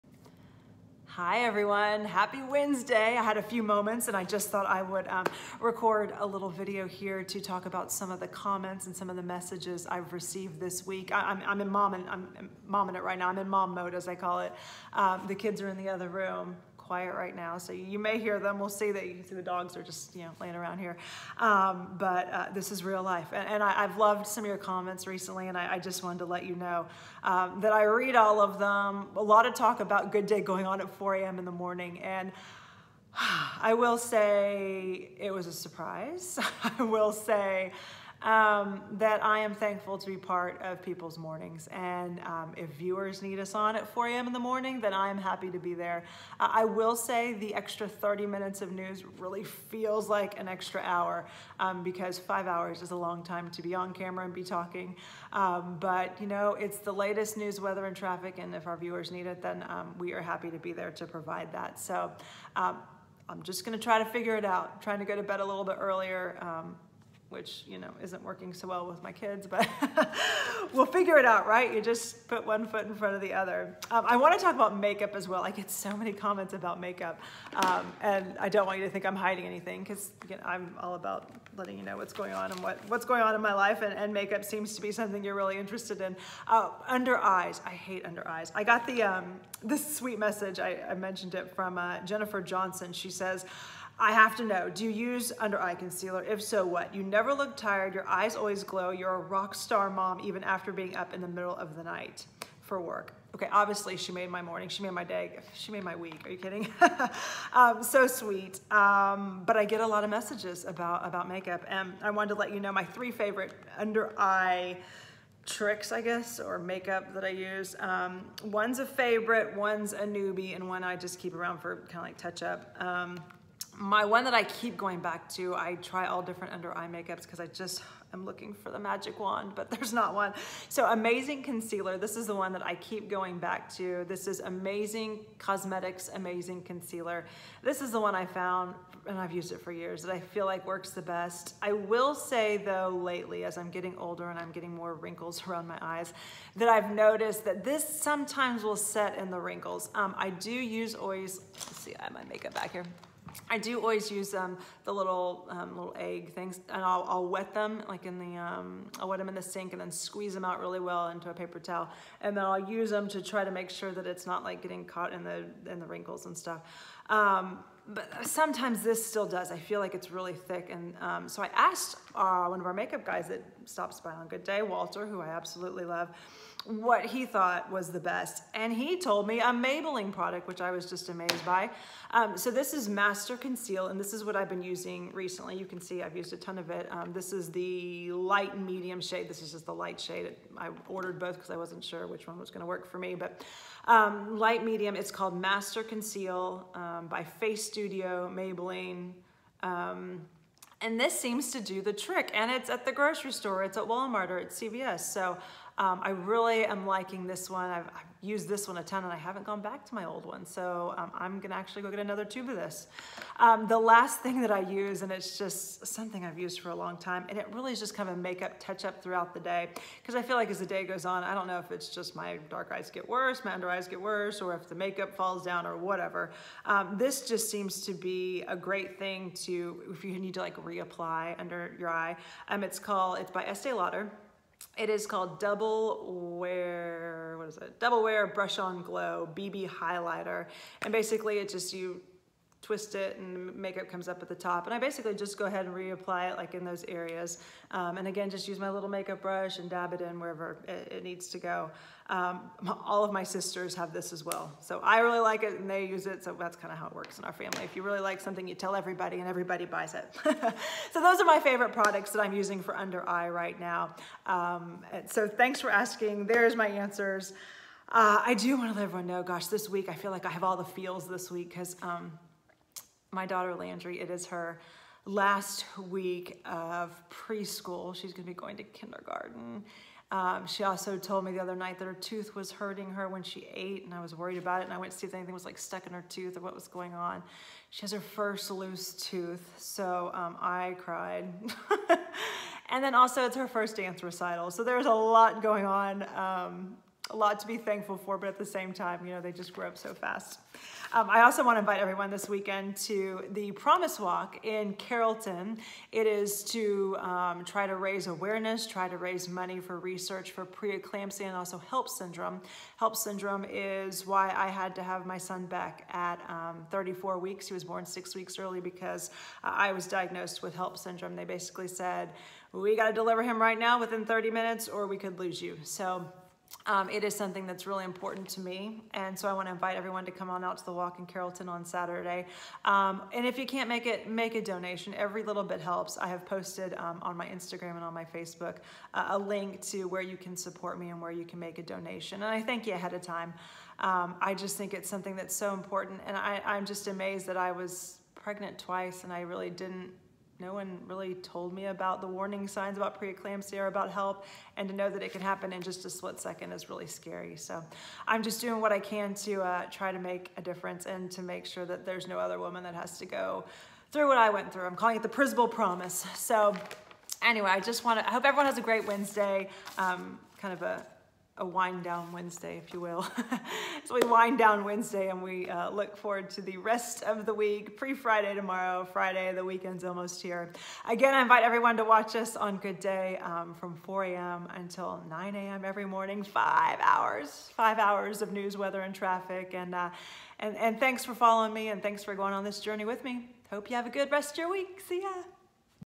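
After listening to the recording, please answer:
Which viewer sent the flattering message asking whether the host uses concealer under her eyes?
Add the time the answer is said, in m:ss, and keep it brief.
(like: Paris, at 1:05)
Jennifer Johnson, at 1:31.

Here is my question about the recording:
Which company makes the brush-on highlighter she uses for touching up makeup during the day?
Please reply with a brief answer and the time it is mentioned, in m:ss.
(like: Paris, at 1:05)
Estee Lauder, at 3:53.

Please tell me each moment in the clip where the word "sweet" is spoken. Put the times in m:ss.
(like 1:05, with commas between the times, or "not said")
1:29, 1:48.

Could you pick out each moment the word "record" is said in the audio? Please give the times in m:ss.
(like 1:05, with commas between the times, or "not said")
0:05.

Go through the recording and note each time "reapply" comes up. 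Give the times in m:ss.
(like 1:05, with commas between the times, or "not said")
3:50, 4:05.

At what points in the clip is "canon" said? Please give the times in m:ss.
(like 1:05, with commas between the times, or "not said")
not said.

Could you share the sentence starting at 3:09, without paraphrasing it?
This is just the light shade.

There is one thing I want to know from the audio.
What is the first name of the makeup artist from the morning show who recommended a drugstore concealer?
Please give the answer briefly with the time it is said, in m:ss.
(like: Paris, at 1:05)
Walter, at 2:54.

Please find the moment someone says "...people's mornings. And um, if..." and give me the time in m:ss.
0:40.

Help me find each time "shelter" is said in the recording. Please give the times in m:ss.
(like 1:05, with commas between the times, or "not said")
not said.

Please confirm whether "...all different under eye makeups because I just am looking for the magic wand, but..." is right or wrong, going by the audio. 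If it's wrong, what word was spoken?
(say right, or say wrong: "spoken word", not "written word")
right.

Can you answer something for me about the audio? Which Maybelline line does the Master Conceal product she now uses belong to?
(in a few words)
Face Studio.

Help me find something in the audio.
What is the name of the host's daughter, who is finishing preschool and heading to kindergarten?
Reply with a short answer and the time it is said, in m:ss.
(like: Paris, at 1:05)
Landry, at 4:33.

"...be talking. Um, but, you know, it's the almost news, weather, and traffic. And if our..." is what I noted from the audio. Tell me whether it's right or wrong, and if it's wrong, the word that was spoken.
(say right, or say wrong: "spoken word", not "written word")
wrong: "latest", not "almost".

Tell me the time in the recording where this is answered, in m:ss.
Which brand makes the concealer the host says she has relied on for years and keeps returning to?
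2:14.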